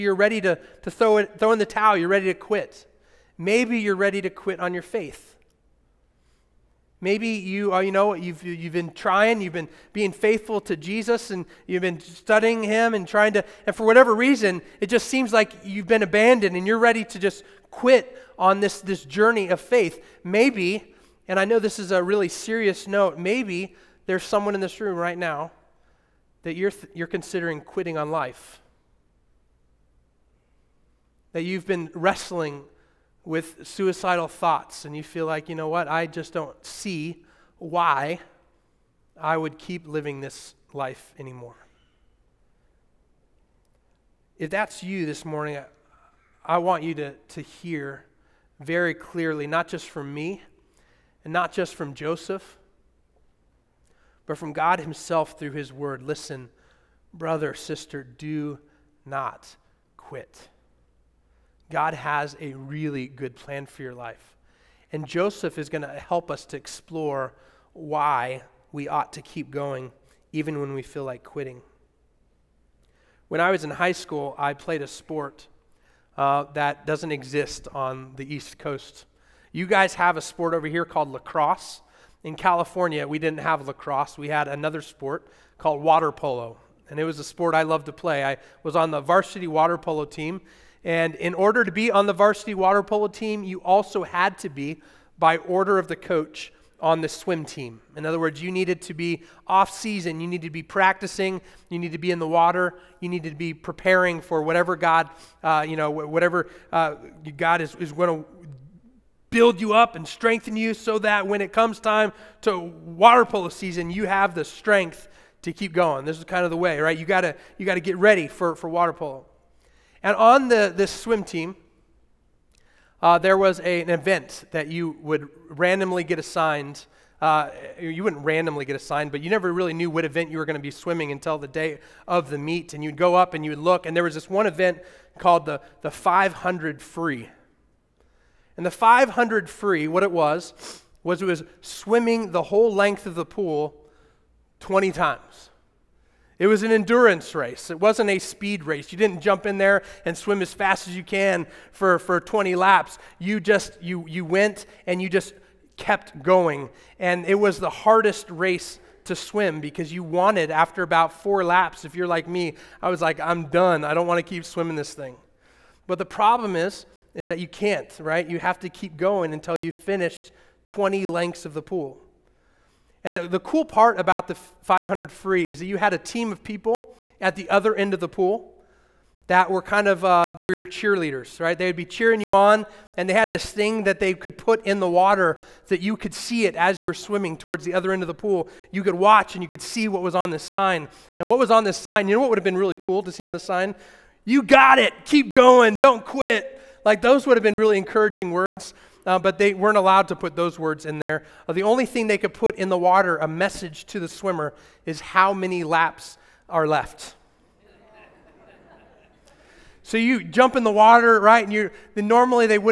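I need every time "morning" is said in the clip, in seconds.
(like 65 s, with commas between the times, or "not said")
45 s.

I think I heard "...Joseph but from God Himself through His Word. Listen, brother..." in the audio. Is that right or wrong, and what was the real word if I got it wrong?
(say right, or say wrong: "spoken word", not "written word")
right.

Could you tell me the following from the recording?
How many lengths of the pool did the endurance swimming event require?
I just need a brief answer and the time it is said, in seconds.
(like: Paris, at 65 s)
20, at 144 s.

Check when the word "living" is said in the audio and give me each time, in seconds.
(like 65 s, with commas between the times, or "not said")
39 s.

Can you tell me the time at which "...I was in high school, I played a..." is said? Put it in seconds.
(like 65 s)
73 s.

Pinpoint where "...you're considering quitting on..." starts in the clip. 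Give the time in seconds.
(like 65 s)
26 s.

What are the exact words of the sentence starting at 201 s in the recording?
Uh, the only thing they could put in the water, a message to the swimmer, is how many laps are left.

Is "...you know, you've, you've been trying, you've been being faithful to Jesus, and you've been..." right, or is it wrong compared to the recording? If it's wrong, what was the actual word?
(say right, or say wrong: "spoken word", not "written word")
right.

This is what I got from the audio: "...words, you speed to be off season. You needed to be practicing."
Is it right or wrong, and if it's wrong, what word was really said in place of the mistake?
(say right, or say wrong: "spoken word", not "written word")
wrong: "needed", not "speed".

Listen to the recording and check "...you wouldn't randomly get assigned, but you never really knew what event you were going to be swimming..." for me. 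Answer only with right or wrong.
right.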